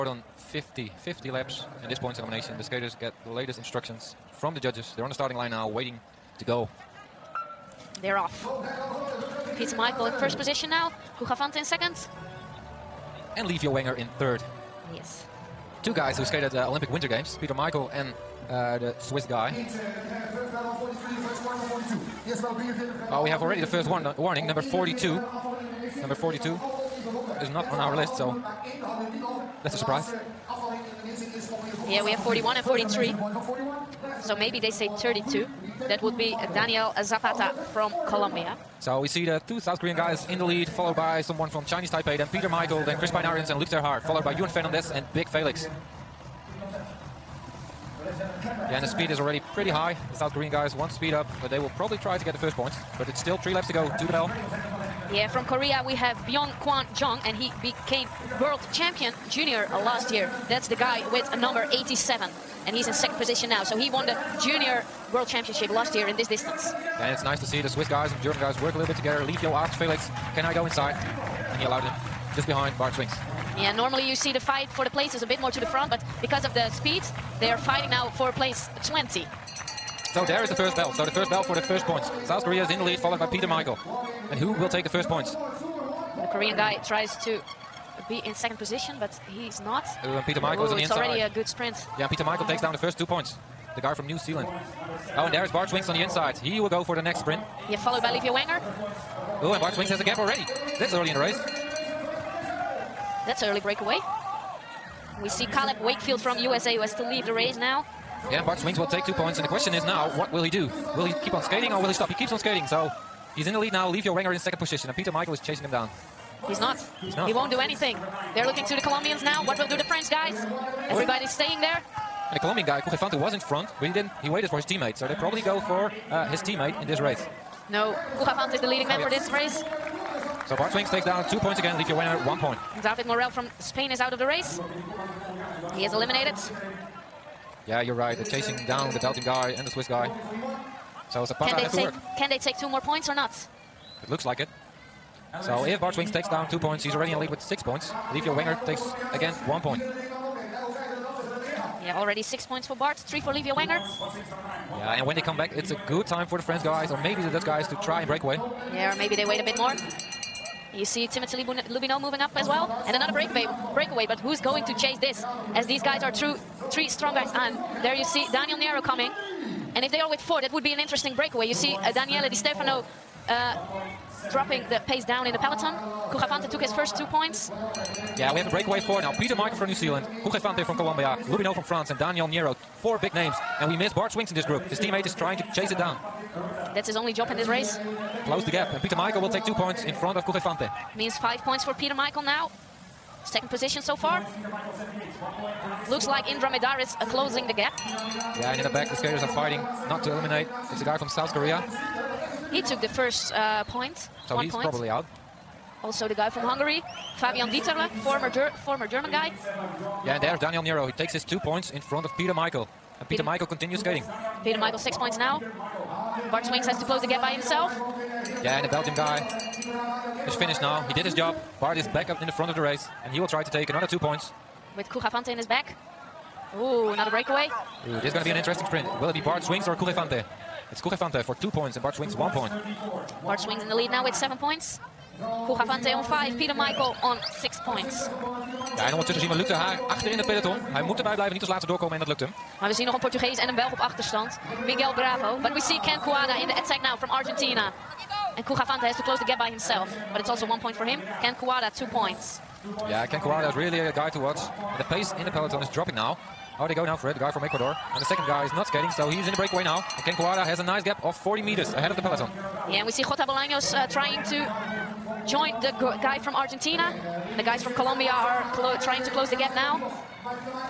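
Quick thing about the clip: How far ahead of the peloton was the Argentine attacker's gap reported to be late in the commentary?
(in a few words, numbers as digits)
40 meters.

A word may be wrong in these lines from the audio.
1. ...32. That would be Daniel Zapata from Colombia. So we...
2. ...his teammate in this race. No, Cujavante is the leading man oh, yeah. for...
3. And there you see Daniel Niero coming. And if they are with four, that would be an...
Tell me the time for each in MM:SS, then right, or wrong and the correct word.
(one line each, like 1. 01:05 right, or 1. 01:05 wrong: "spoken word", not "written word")
1. 00:34 right
2. 02:06 right
3. 02:47 right.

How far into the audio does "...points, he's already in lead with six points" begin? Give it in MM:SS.
02:26.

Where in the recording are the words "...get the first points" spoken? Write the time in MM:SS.
00:52.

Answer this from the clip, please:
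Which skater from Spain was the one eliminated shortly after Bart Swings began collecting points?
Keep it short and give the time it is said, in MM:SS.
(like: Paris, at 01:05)
David Morel, at 02:12.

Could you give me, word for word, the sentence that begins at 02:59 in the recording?
Peter Michael from New Zealand, Cujavante from Colombia, Loubineaud from France, and Daniel Niero.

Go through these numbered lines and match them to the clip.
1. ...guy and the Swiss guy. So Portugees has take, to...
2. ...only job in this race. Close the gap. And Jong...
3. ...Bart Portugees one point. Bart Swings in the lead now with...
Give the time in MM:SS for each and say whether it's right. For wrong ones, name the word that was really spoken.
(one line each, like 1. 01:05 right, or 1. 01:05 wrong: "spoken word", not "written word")
1. 02:19 wrong: "Zapata", not "Portugees"
2. 03:06 wrong: "Peter", not "Jong"
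3. 03:51 wrong: "Swings", not "Portugees".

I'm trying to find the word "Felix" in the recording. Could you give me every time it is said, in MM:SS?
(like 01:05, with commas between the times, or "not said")
00:45, 01:09.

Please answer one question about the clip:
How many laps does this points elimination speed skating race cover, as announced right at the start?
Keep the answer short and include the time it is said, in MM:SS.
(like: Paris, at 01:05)
50, at 00:01.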